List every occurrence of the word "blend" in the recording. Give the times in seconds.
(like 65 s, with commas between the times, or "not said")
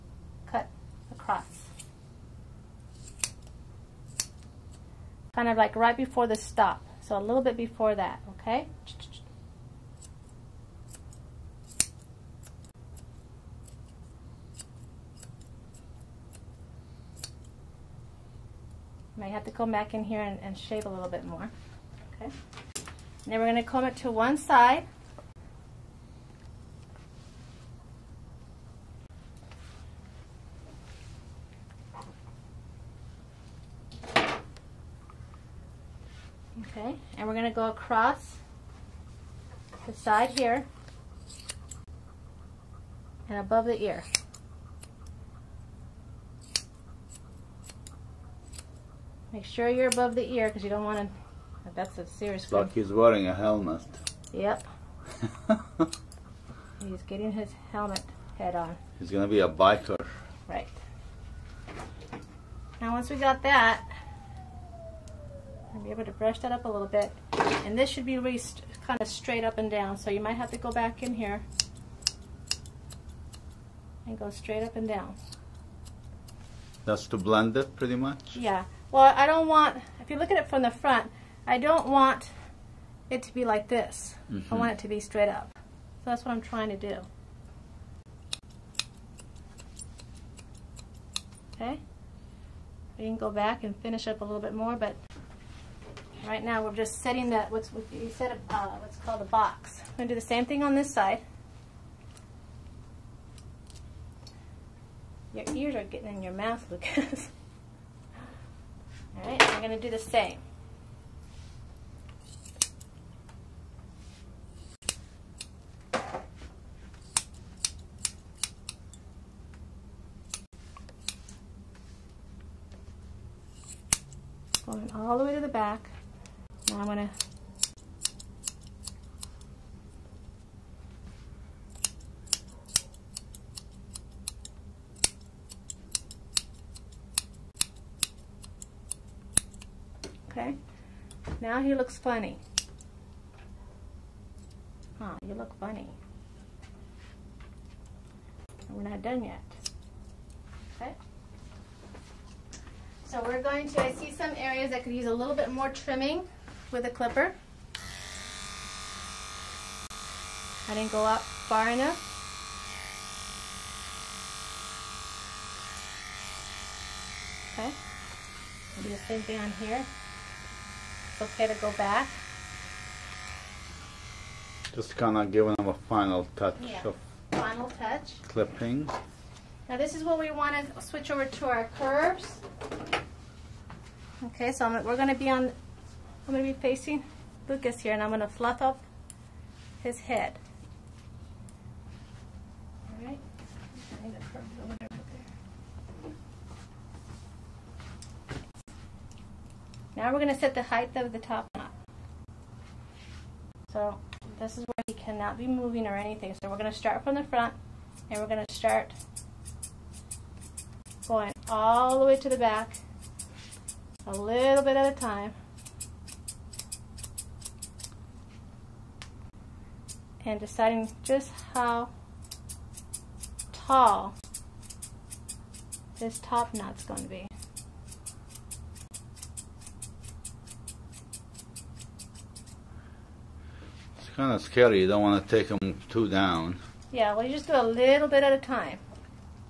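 77 s.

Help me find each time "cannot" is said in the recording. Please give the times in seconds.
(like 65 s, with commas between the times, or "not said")
204 s.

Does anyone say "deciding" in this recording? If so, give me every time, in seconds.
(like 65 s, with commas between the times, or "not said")
220 s.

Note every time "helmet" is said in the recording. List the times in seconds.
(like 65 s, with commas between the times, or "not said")
53 s, 57 s.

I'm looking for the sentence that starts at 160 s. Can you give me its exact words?
I didn't go up far enough.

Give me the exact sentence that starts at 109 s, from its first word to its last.
All right, I'm gonna do the same.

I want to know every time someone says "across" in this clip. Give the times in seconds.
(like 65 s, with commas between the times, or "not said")
1 s, 37 s.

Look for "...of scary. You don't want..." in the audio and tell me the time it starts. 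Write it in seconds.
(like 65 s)
234 s.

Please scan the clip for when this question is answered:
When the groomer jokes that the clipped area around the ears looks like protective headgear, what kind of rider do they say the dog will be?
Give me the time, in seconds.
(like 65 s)
59 s.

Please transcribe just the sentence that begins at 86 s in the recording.
So that's what I'm trying to do.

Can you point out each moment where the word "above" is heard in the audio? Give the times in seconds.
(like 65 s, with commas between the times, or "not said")
43 s, 49 s.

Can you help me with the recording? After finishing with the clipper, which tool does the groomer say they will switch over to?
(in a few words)
Curves.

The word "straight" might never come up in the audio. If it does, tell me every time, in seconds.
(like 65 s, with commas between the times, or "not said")
69 s, 74 s, 84 s.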